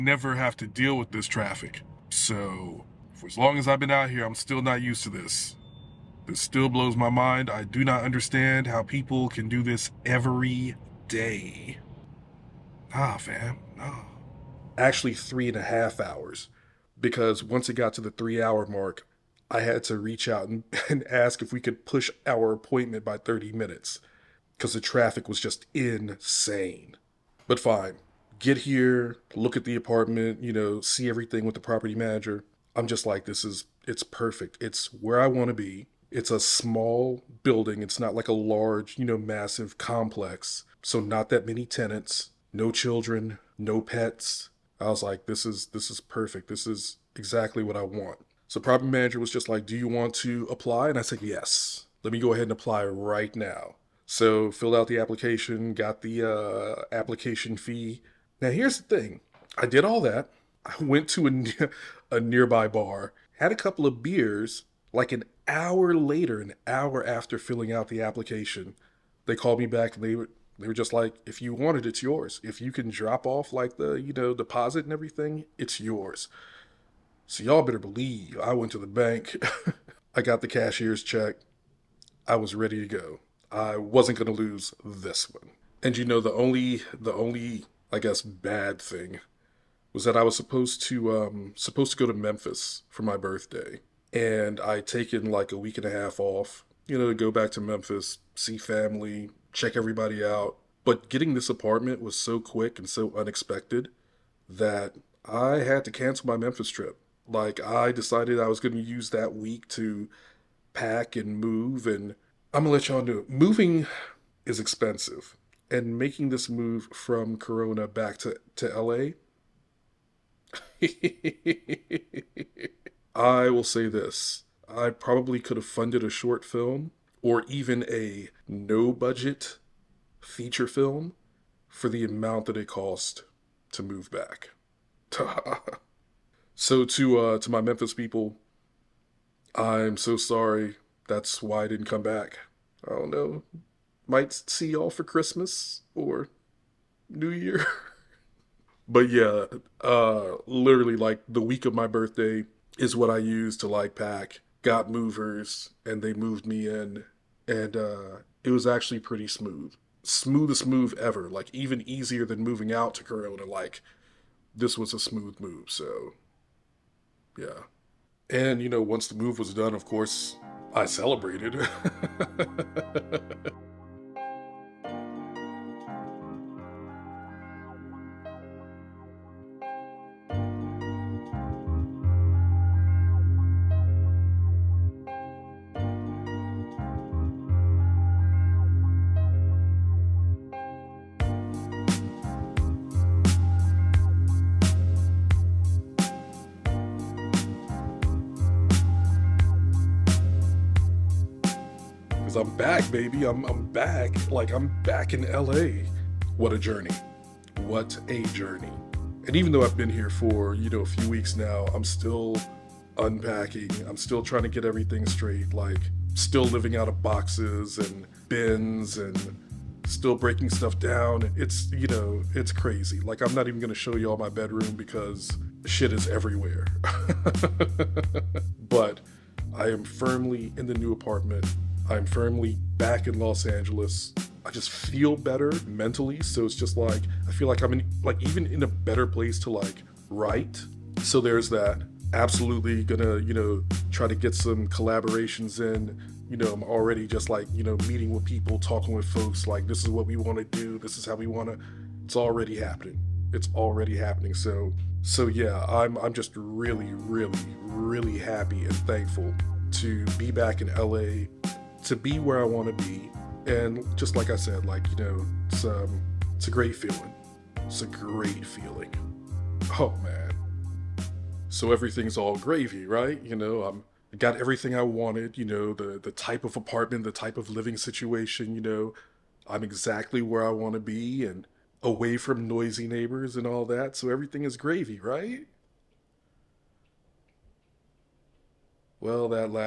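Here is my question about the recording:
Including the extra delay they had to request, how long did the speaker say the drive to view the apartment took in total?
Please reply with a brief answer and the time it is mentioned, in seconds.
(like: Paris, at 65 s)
3.5 hours, at 15 s.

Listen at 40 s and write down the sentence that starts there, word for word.
So, not that many tenants, no children, no pets, I was like, this is this is perfect.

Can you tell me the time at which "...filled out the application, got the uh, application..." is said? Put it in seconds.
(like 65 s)
54 s.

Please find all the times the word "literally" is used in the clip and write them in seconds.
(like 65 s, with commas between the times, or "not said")
150 s.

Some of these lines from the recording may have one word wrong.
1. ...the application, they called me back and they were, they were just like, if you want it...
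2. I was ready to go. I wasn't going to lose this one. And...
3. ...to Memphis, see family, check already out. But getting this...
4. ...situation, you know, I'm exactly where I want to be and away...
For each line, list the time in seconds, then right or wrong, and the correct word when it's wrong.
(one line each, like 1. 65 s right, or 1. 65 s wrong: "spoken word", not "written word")
1. 67 s right
2. 82 s right
3. 97 s wrong: "everybody", not "already"
4. 277 s right.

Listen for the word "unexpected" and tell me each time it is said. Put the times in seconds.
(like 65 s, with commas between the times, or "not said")
103 s.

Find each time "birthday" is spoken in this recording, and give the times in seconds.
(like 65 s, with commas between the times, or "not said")
93 s, 151 s.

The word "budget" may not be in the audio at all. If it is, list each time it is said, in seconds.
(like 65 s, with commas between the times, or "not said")
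128 s.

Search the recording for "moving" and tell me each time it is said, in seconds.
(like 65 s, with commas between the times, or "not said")
113 s, 162 s.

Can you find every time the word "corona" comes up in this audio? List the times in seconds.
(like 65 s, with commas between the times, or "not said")
117 s, 163 s.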